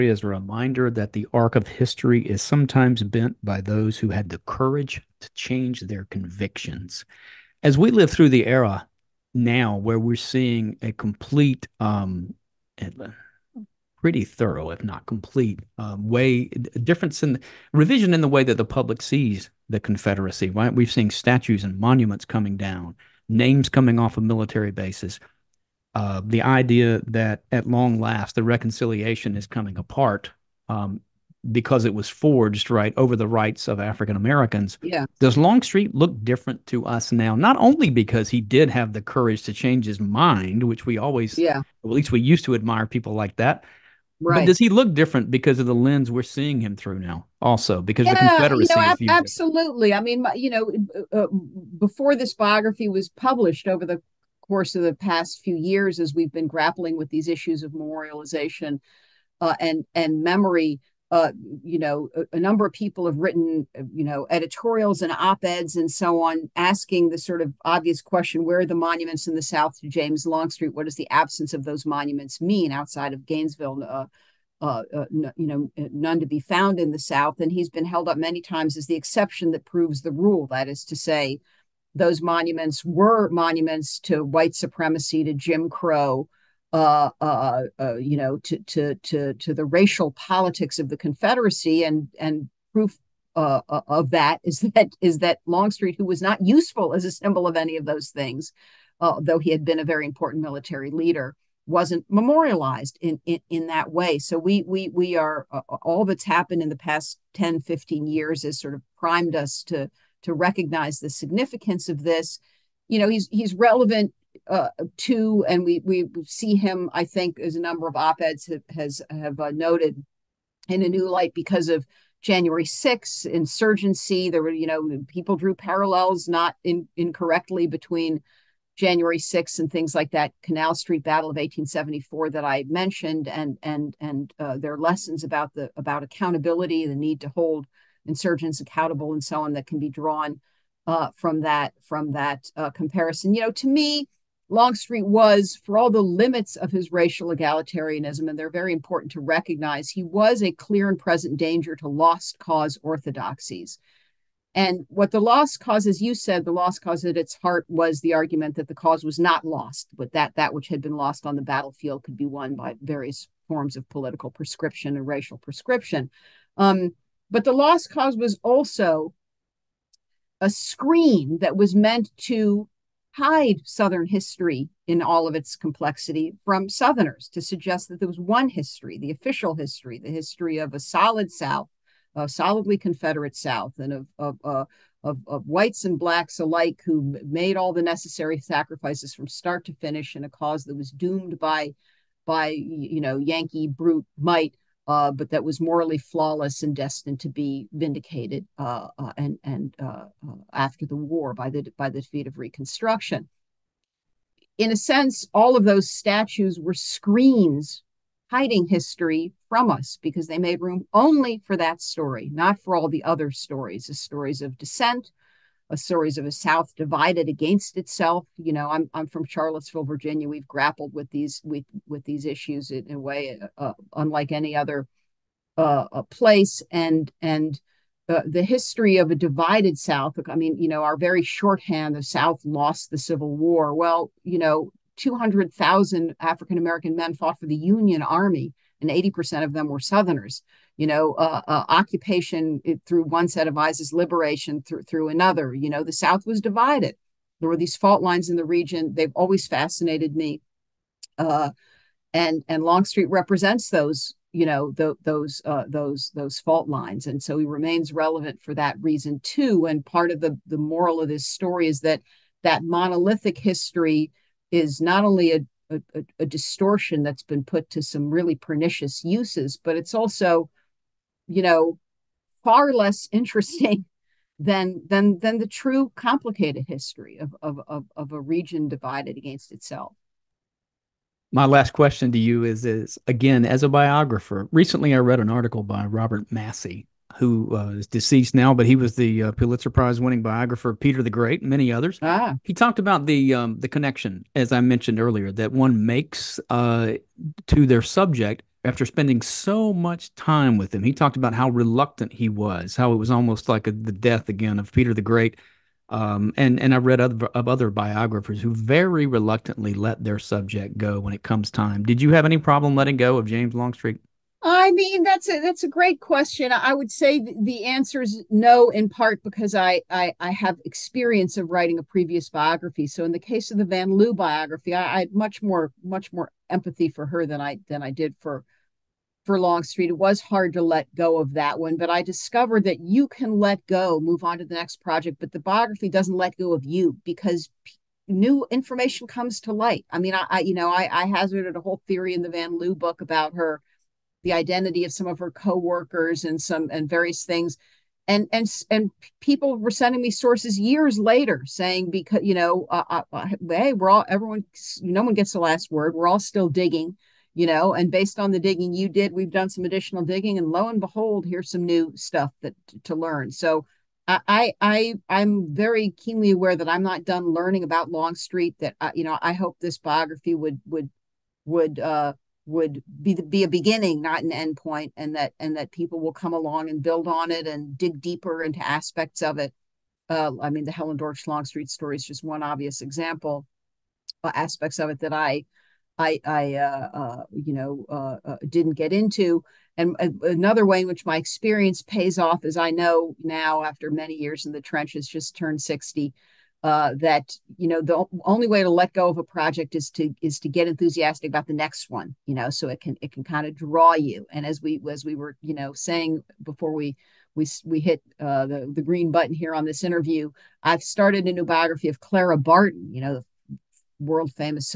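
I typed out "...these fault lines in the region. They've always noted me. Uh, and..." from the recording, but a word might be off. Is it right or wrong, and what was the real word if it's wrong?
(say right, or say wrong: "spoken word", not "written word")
wrong: "fascinated", not "noted".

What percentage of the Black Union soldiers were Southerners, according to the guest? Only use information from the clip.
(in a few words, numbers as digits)
80%.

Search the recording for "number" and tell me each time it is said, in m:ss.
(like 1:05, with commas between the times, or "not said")
1:02, 1:57.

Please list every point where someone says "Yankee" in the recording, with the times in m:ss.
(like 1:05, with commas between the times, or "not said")
3:13.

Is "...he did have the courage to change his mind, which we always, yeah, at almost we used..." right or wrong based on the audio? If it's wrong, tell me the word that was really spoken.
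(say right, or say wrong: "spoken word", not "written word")
wrong: "least", not "almost".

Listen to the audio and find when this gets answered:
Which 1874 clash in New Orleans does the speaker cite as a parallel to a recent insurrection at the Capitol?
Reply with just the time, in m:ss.
2:10.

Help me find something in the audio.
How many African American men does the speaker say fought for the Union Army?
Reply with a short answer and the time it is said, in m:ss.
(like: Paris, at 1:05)
200,000, at 3:54.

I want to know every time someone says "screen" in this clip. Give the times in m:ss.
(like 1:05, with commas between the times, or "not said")
2:50, 3:26.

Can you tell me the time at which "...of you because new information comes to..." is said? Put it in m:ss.
5:36.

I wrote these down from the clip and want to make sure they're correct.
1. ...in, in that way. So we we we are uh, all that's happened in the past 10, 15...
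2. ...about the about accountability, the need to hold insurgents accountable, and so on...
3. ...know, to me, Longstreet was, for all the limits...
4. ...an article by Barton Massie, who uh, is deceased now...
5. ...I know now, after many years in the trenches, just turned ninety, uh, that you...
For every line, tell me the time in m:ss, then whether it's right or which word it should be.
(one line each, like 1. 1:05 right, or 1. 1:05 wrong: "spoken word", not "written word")
1. 1:43 right
2. 2:15 right
3. 2:23 right
4. 4:45 wrong: "Robert", not "Barton"
5. 6:32 wrong: "sixty", not "ninety".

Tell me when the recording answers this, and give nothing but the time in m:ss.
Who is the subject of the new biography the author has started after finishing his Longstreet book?
6:52.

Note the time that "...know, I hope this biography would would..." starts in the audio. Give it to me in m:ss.
6:09.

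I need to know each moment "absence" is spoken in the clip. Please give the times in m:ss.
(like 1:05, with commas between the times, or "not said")
1:11.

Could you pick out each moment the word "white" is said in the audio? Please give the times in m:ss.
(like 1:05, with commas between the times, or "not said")
1:24, 3:05.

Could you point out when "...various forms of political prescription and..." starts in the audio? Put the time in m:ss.
2:42.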